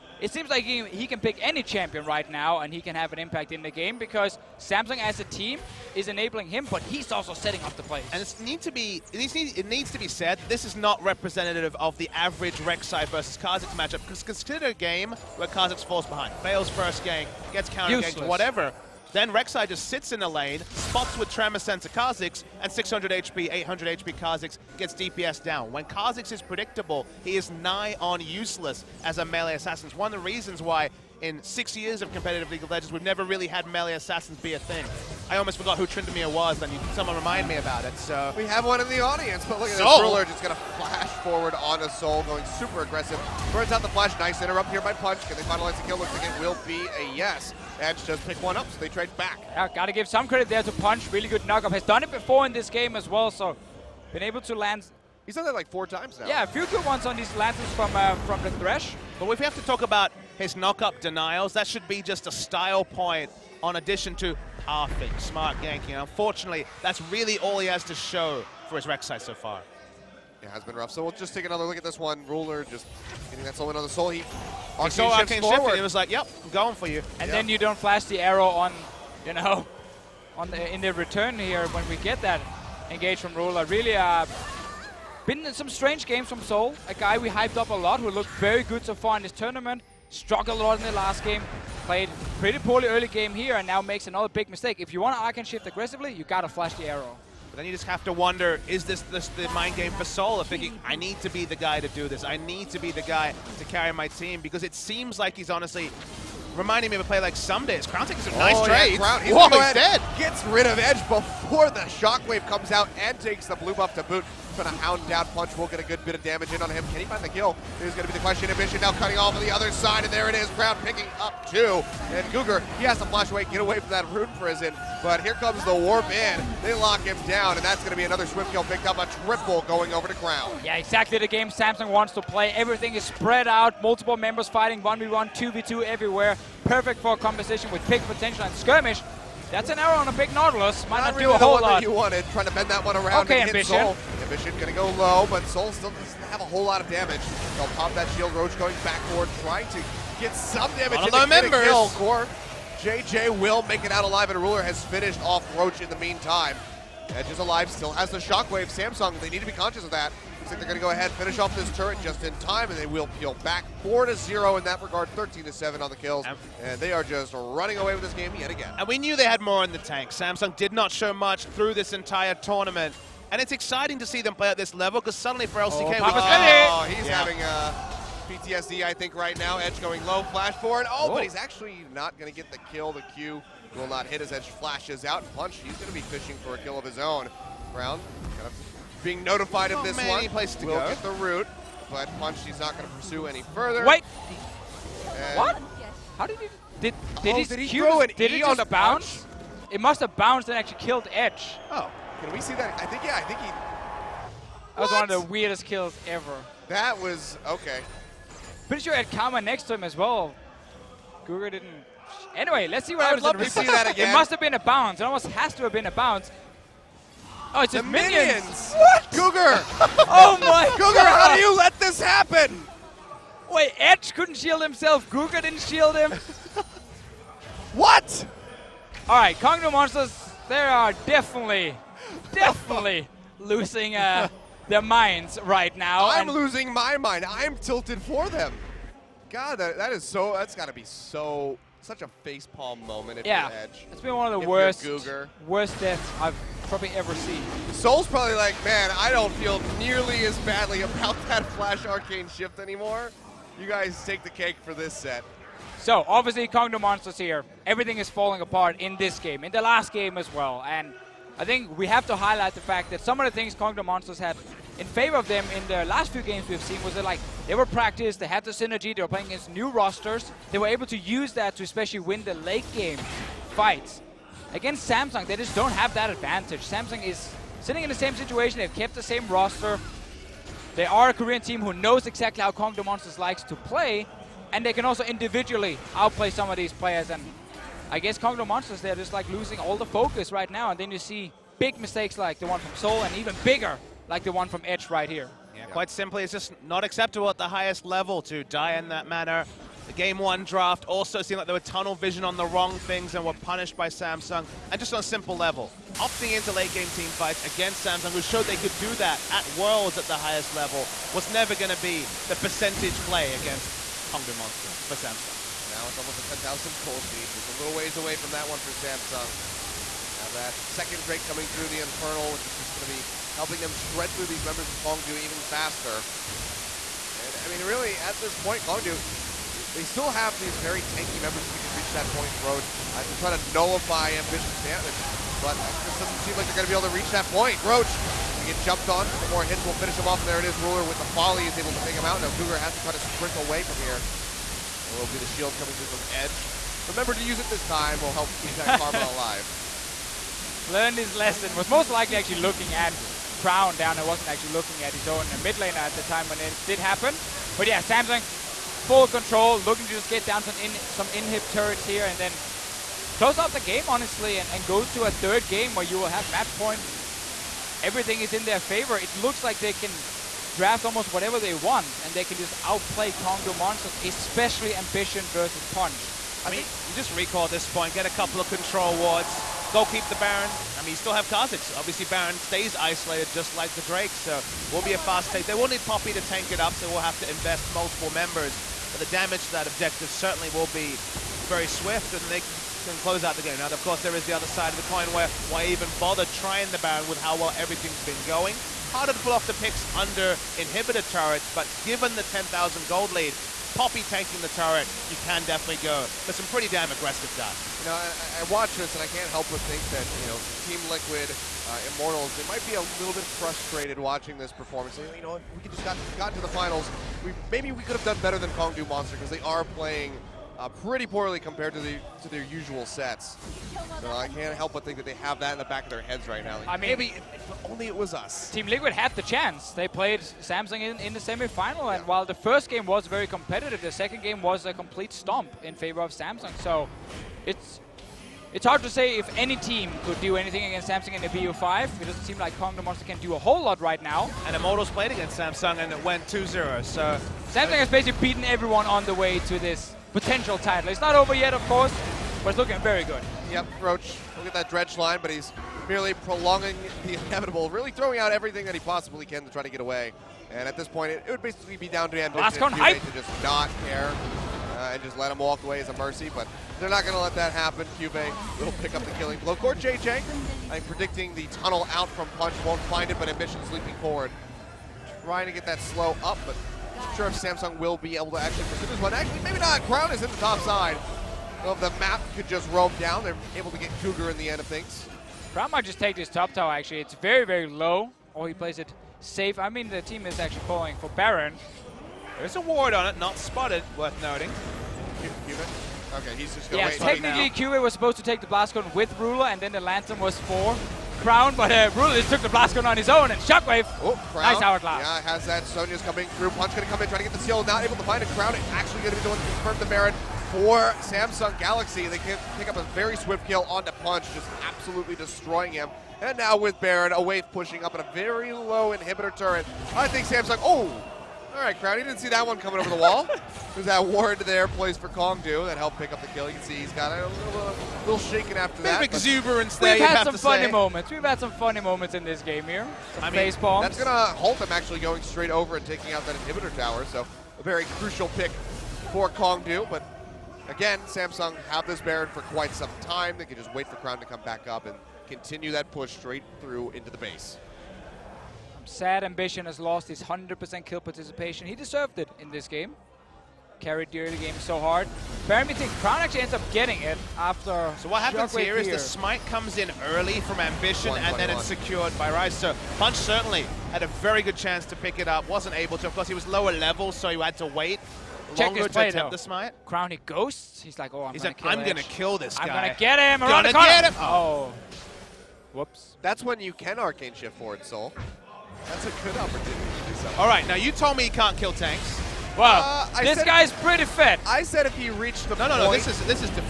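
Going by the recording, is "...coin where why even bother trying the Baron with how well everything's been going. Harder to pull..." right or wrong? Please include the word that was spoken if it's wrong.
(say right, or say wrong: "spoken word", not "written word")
right.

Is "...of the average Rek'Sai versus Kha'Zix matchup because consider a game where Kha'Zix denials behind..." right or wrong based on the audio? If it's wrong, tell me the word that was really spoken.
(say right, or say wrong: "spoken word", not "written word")
wrong: "falls", not "denials".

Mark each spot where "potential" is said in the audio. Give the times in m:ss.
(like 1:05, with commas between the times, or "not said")
2:18, 7:30.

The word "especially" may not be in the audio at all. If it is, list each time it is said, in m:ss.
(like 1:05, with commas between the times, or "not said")
4:31, 6:14.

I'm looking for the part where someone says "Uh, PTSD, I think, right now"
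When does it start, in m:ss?
2:57.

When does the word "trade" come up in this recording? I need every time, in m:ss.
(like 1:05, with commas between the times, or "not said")
0:48.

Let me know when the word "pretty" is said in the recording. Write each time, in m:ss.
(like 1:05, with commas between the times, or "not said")
1:32, 3:28, 6:46, 7:00, 9:43.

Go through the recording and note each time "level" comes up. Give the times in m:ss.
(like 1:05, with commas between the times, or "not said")
2:54, 4:57, 5:05, 5:10, 9:26.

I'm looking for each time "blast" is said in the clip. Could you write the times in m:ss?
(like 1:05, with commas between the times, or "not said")
8:18, 8:22.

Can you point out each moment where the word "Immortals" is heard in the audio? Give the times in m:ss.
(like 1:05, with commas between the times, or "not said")
6:51, 7:24.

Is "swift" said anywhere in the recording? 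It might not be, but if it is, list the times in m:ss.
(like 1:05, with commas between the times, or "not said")
2:08, 6:31, 8:33.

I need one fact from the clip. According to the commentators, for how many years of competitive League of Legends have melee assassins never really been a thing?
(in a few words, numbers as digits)
6.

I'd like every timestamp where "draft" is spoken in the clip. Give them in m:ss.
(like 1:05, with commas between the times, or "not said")
5:00, 6:10.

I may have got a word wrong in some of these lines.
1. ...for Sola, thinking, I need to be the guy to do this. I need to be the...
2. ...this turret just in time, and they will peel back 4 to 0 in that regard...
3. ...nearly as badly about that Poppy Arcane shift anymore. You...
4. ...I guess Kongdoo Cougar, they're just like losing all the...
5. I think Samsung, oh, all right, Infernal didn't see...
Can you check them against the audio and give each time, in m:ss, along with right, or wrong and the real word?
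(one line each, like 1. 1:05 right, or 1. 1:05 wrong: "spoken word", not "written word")
1. 1:39 right
2. 2:41 right
3. 4:09 wrong: "Flash", not "Poppy"
4. 4:47 wrong: "Monsters", not "Cougar"
5. 8:39 wrong: "Crowdy", not "Infernal".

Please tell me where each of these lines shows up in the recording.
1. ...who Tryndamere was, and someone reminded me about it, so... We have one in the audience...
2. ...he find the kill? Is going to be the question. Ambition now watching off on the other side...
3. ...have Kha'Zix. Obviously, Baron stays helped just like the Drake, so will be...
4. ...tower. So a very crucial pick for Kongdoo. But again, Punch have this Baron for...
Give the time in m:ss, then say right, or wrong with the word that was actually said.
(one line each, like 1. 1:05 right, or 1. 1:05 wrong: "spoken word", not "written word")
1. 0:35 right
2. 1:57 wrong: "cutting", not "watching"
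3. 6:21 wrong: "isolated", not "helped"
4. 8:56 wrong: "Samsung", not "Punch".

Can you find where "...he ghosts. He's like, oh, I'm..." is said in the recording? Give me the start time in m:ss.
9:30.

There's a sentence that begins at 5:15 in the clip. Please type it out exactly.
Now it's almost a 10,000 cold lead, just a little ways away from that one for Samsung.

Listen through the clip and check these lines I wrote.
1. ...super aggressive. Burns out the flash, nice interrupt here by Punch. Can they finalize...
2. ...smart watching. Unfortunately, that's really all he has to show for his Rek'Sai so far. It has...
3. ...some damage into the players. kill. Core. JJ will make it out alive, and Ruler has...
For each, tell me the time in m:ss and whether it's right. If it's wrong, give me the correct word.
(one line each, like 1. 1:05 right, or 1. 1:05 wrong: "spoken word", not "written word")
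1. 0:42 right
2. 1:05 wrong: "ganking", not "watching"
3. 2:30 wrong: "members", not "players".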